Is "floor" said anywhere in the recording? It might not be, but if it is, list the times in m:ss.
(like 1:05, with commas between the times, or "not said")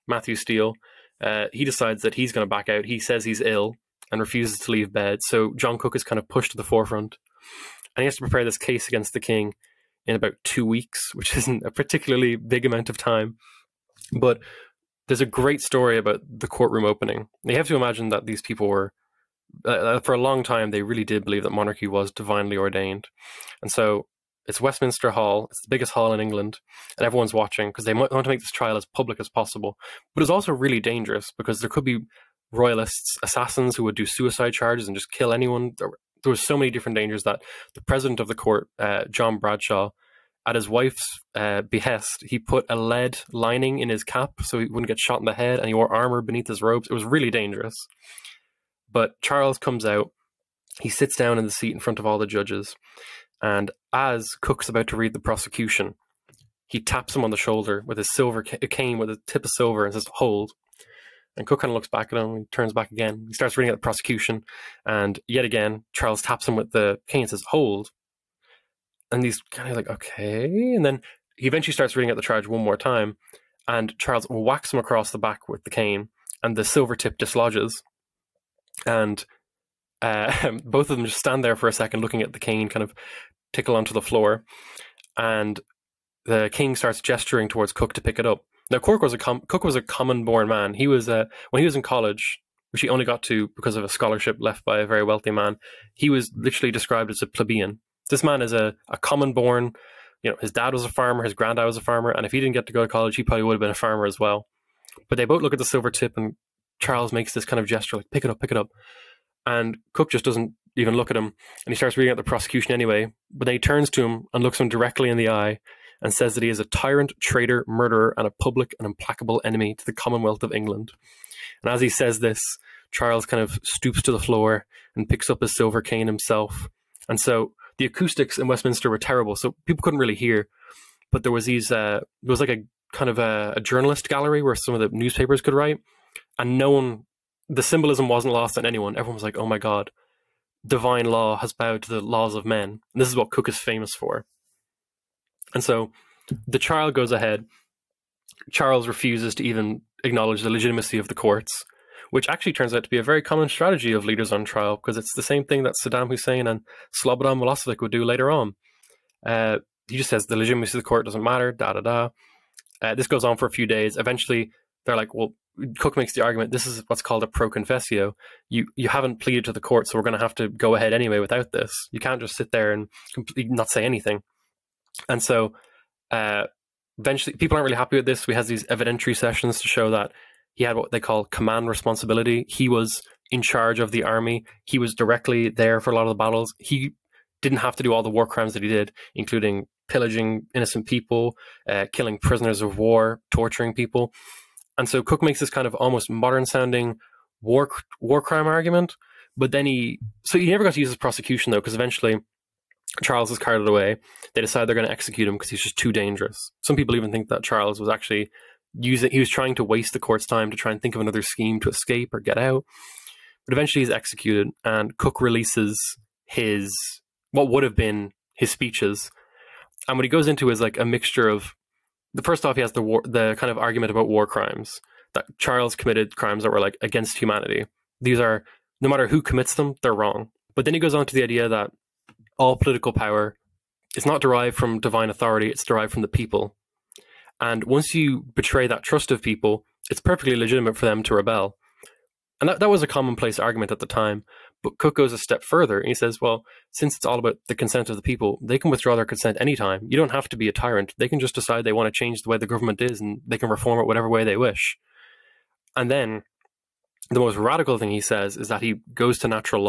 1:24, 2:04.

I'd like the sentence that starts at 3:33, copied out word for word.
But eventually he's executed and Cook releases his what would have been his speeches.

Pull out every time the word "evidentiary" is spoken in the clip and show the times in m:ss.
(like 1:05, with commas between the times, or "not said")
2:58.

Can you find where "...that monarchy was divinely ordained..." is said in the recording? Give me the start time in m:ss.
0:21.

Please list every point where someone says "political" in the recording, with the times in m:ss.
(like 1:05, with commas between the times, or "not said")
3:52.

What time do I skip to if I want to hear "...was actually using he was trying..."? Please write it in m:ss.
3:27.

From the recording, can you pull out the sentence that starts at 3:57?
And once you betray that trust of people, it's perfectly legitimate for them to rebel.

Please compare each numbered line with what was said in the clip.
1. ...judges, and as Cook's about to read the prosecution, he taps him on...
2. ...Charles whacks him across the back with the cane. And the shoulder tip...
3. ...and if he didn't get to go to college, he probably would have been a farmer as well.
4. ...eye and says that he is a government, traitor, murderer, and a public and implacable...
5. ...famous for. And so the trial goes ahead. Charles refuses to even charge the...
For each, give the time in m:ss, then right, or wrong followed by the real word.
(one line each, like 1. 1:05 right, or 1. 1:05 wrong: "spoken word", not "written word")
1. 0:52 right
2. 1:13 wrong: "silver", not "shoulder"
3. 1:42 right
4. 1:55 wrong: "tyrant", not "government"
5. 2:23 wrong: "acknowledge", not "charge".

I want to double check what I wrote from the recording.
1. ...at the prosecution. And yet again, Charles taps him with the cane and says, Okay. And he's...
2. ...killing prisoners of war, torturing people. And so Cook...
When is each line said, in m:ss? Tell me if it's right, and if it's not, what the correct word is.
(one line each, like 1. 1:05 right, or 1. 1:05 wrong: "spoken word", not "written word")
1. 1:03 wrong: "Hold", not "Okay"
2. 3:11 right.